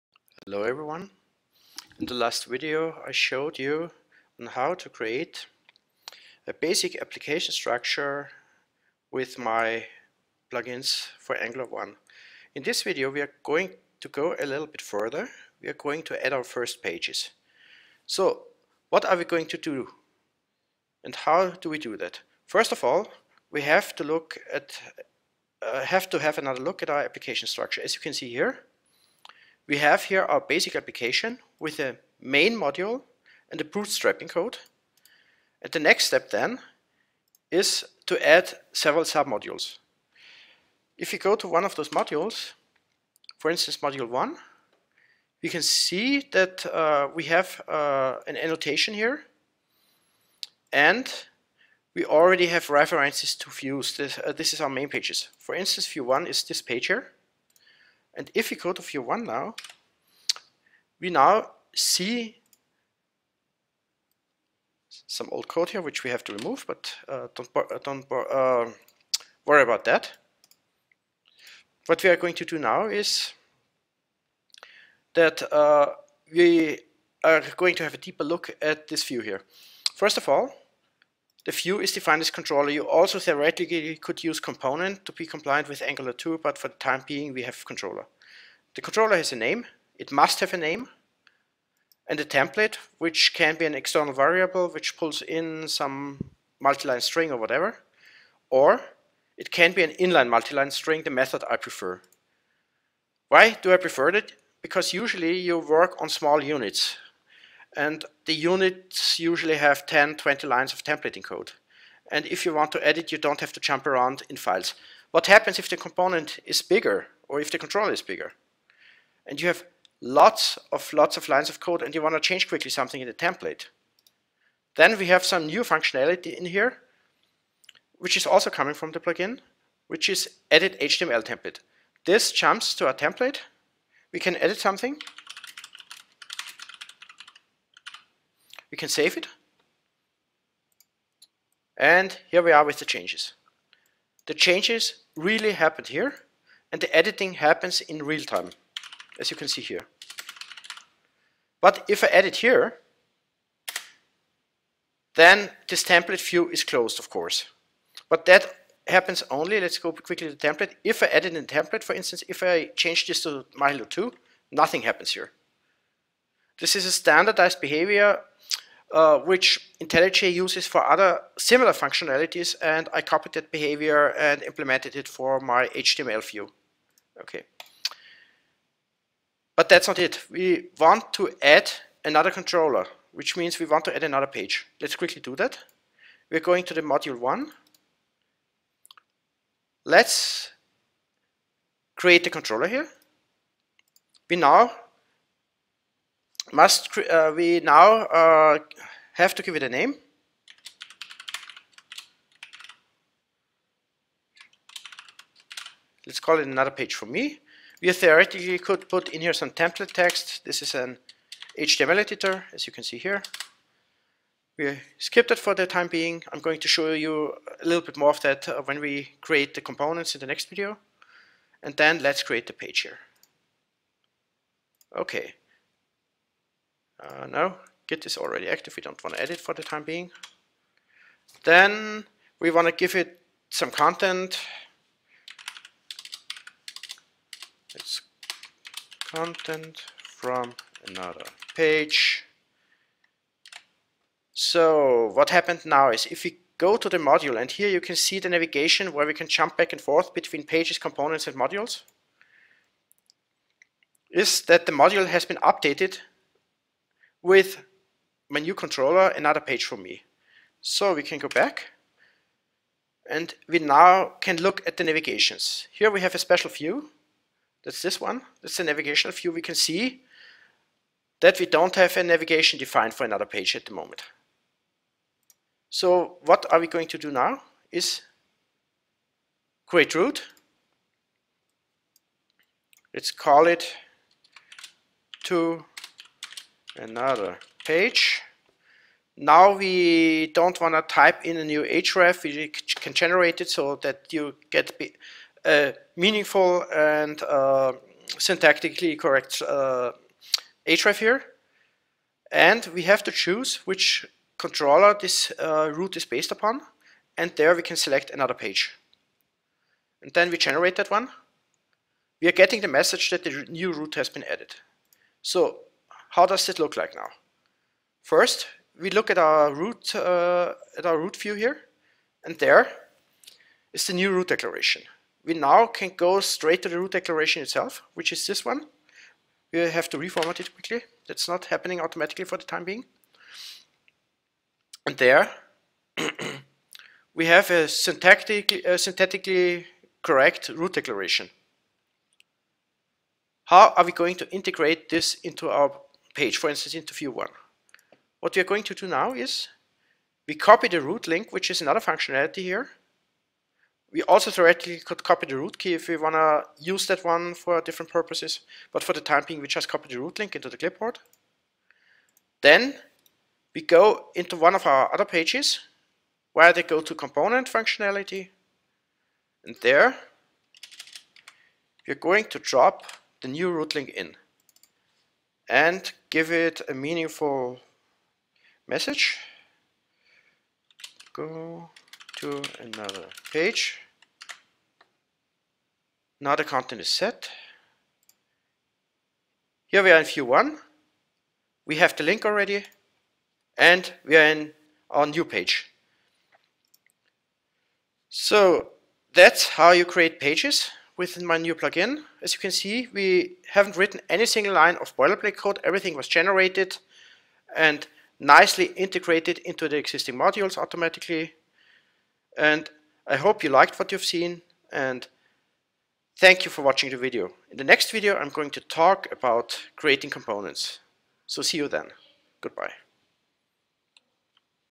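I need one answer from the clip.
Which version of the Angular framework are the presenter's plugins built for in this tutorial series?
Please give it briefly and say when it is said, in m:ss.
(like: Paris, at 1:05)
Angular 1, at 0:11.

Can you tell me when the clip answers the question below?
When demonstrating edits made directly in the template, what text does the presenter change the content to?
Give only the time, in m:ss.
2:43.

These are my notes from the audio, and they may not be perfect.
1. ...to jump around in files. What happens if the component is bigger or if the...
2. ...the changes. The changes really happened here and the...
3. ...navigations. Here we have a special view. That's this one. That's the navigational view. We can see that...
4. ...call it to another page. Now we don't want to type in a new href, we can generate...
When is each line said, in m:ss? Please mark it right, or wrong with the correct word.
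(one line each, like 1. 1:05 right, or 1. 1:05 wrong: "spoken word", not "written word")
1. 1:53 right
2. 2:22 right
3. 4:24 right
4. 4:43 right.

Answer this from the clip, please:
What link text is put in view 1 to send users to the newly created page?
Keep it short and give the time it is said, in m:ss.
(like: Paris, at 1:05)
Go to another page, at 6:21.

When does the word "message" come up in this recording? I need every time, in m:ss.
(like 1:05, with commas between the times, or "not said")
5:12, 6:18.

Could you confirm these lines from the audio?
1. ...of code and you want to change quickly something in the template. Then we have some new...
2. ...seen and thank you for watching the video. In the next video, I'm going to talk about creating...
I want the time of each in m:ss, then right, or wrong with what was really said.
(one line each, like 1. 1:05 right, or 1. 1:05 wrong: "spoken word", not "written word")
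1. 2:01 right
2. 6:54 right.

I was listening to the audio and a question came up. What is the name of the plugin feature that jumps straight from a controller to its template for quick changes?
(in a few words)
edit HTML template.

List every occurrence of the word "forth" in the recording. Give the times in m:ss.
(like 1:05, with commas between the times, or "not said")
4:09.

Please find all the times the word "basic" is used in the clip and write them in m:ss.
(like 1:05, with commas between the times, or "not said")
0:06, 0:30.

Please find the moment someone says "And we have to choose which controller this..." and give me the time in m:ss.
5:02.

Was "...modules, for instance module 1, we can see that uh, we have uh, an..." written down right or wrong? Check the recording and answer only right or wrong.
right.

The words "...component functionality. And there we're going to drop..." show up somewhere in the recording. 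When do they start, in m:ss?
6:06.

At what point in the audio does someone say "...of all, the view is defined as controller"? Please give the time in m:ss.
1:20.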